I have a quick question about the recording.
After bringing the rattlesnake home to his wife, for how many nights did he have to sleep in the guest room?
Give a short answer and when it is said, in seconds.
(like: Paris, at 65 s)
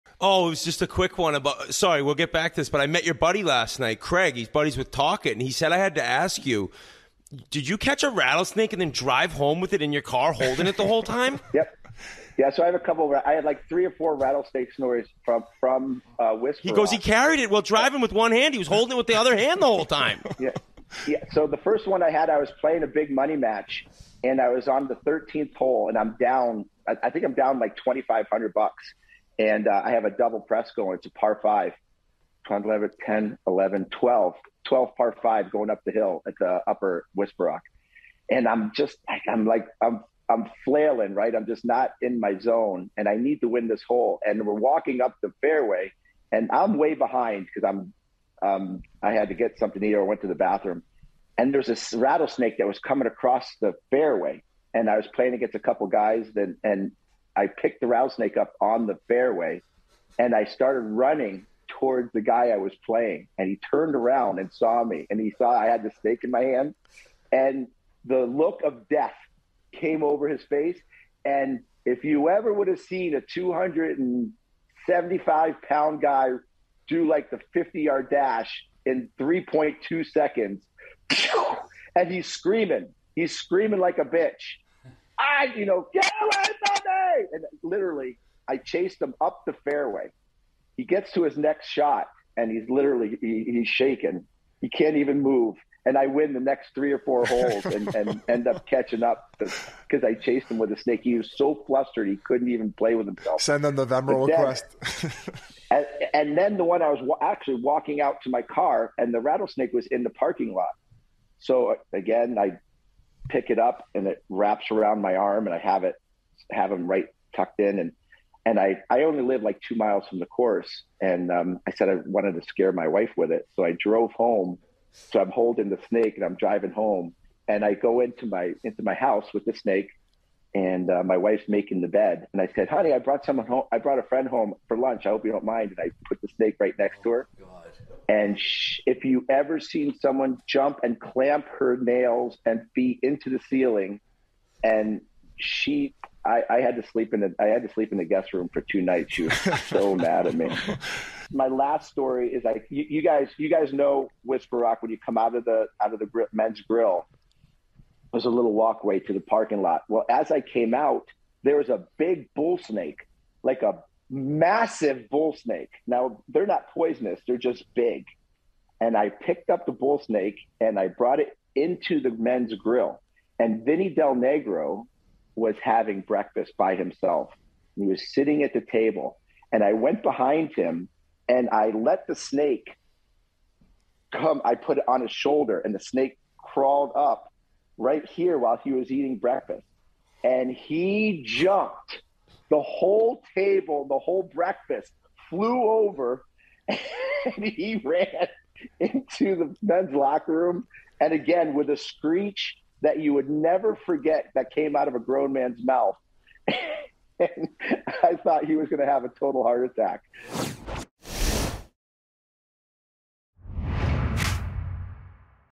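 2, at 148 s.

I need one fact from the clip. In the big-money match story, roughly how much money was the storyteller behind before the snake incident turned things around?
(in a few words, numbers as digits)
$2,500.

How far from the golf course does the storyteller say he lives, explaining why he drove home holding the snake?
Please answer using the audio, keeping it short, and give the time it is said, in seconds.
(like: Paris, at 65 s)
2 miles, at 119 s.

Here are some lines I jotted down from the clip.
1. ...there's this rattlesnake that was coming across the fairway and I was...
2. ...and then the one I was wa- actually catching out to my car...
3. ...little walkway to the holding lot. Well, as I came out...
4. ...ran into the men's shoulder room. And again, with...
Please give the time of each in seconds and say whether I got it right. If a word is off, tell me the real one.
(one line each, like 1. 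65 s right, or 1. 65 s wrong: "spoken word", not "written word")
1. 51 s right
2. 106 s wrong: "walking", not "catching"
3. 158 s wrong: "parking", not "holding"
4. 197 s wrong: "locker", not "shoulder".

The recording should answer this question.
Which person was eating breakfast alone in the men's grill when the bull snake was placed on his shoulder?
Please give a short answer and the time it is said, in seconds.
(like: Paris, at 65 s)
Vinny Del Negro, at 173 s.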